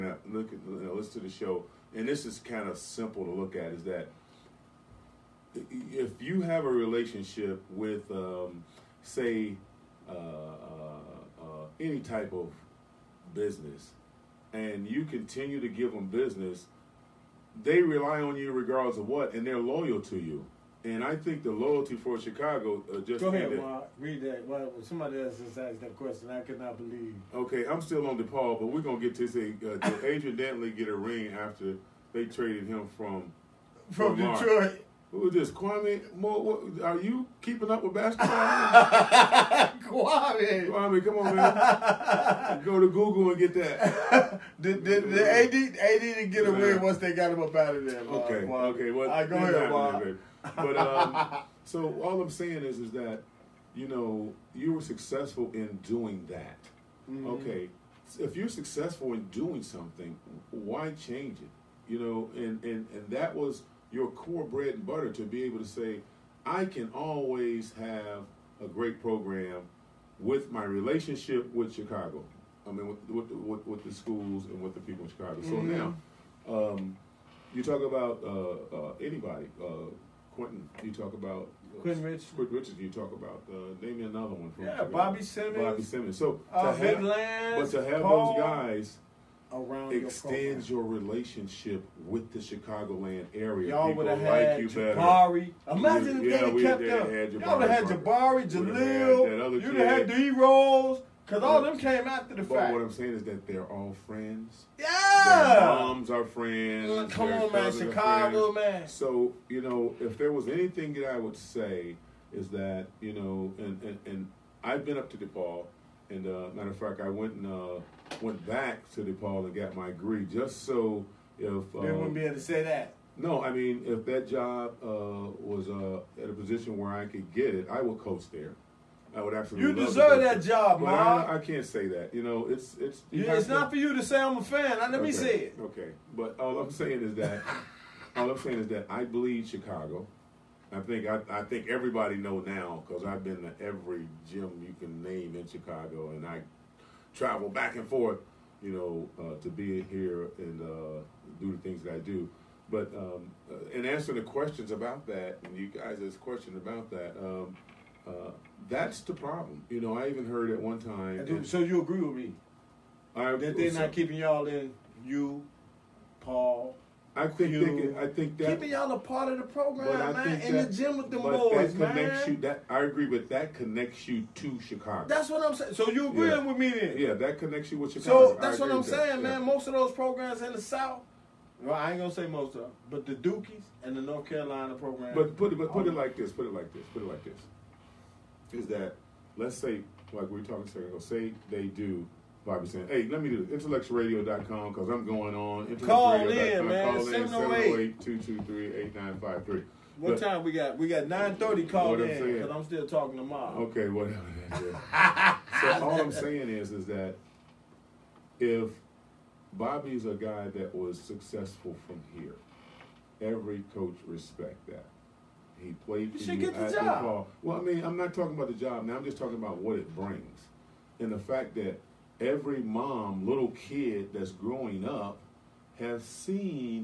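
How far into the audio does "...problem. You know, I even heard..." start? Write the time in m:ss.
2:39.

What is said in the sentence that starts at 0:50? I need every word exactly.
But um, so all I'm saying is, is that you know you were successful in doing that.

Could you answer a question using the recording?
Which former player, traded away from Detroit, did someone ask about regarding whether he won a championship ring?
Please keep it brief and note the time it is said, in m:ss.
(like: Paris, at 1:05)
Adrian Dantley, at 0:30.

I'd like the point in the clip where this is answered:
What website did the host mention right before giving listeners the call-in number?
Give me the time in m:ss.
3:13.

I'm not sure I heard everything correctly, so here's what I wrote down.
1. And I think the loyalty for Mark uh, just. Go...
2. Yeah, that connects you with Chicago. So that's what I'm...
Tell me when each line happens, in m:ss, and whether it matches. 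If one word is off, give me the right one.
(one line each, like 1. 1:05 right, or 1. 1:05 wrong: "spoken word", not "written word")
1. 0:20 wrong: "Chicago", not "Mark"
2. 2:56 right.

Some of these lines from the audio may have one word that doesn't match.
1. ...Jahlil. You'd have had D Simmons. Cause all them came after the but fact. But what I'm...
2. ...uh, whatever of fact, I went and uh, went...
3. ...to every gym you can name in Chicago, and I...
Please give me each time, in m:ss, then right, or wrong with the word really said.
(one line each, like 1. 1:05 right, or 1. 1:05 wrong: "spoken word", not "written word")
1. 1:38 wrong: "Rose", not "Simmons"
2. 1:56 wrong: "matter", not "whatever"
3. 2:23 right.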